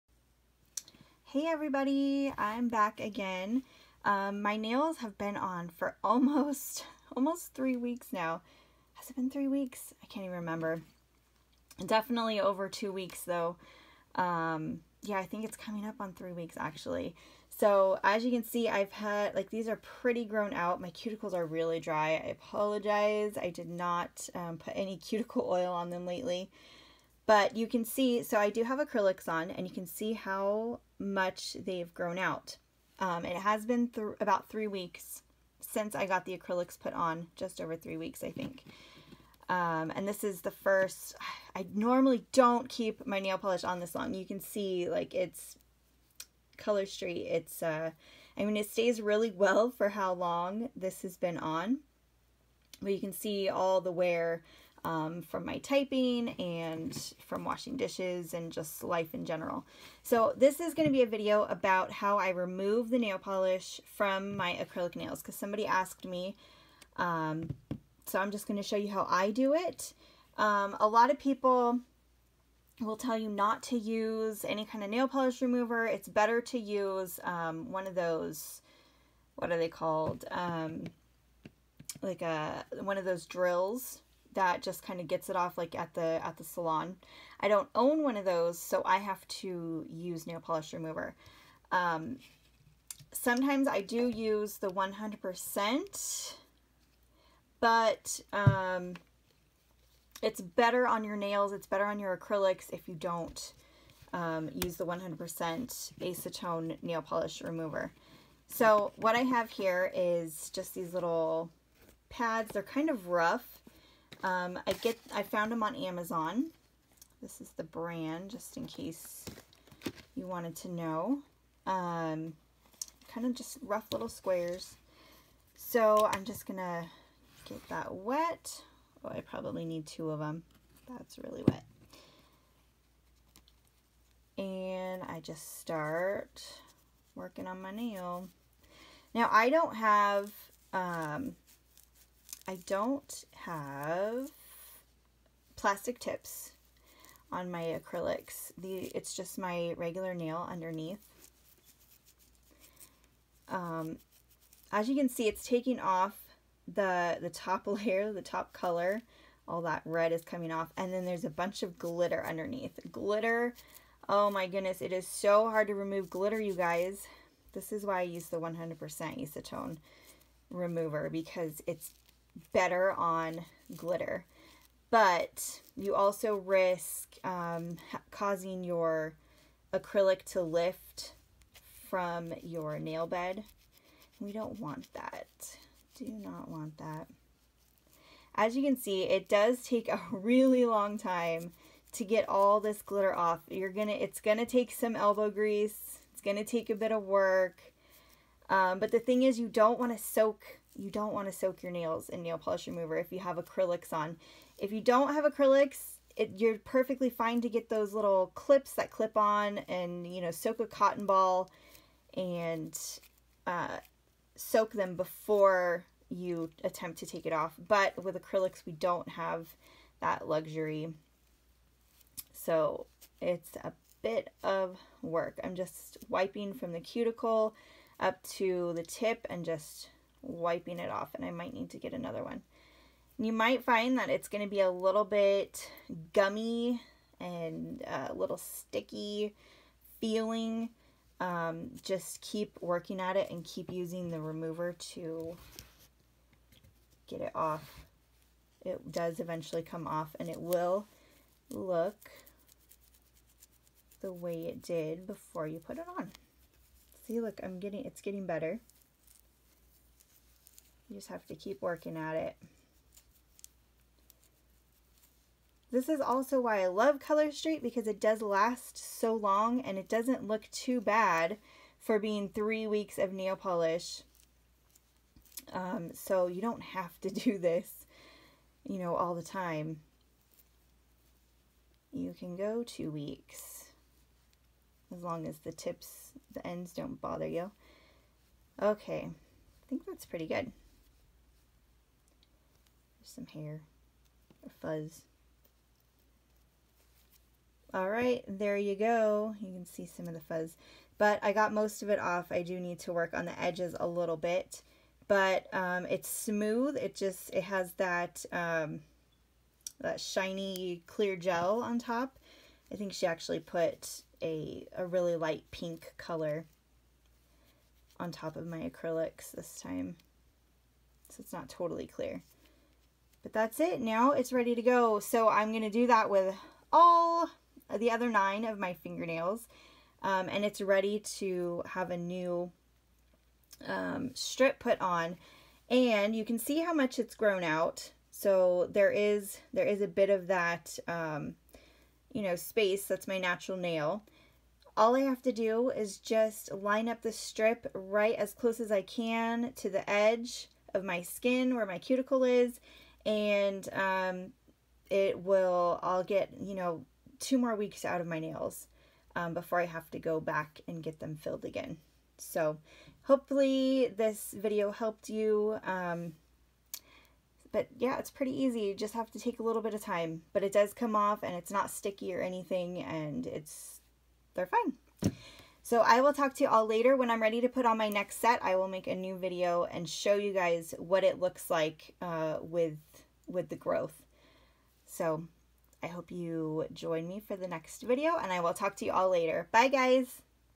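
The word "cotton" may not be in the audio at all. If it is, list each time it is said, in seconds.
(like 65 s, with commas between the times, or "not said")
210 s.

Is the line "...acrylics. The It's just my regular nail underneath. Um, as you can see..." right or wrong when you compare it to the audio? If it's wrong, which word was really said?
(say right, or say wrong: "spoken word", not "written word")
right.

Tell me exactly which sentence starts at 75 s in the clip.
It's better to use um, one of those, what are they called?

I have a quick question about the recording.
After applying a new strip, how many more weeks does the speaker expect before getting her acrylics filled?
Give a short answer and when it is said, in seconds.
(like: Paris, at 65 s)
2, at 357 s.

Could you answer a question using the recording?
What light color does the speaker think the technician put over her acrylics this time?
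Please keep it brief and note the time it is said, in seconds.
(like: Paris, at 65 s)
light pink, at 315 s.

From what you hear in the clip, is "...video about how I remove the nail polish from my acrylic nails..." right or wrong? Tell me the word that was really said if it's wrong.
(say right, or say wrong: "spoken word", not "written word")
right.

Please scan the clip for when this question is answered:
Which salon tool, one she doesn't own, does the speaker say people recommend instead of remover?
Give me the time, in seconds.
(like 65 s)
83 s.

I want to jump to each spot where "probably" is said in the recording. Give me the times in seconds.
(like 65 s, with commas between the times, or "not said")
129 s.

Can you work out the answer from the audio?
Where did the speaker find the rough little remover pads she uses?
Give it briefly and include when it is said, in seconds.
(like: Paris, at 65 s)
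Amazon, at 115 s.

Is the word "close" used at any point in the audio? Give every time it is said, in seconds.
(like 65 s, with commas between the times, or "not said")
348 s.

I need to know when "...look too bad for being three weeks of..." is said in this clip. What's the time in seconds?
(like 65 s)
270 s.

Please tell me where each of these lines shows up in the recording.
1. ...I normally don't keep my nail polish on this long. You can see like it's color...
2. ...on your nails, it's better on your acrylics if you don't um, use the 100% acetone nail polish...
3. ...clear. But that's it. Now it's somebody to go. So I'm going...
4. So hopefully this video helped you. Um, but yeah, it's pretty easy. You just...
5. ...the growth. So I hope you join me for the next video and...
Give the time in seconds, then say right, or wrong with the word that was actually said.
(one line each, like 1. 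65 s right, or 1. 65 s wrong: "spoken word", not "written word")
1. 41 s right
2. 100 s right
3. 321 s wrong: "ready", not "somebody"
4. 362 s right
5. 383 s right.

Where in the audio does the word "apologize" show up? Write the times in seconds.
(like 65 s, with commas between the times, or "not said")
22 s.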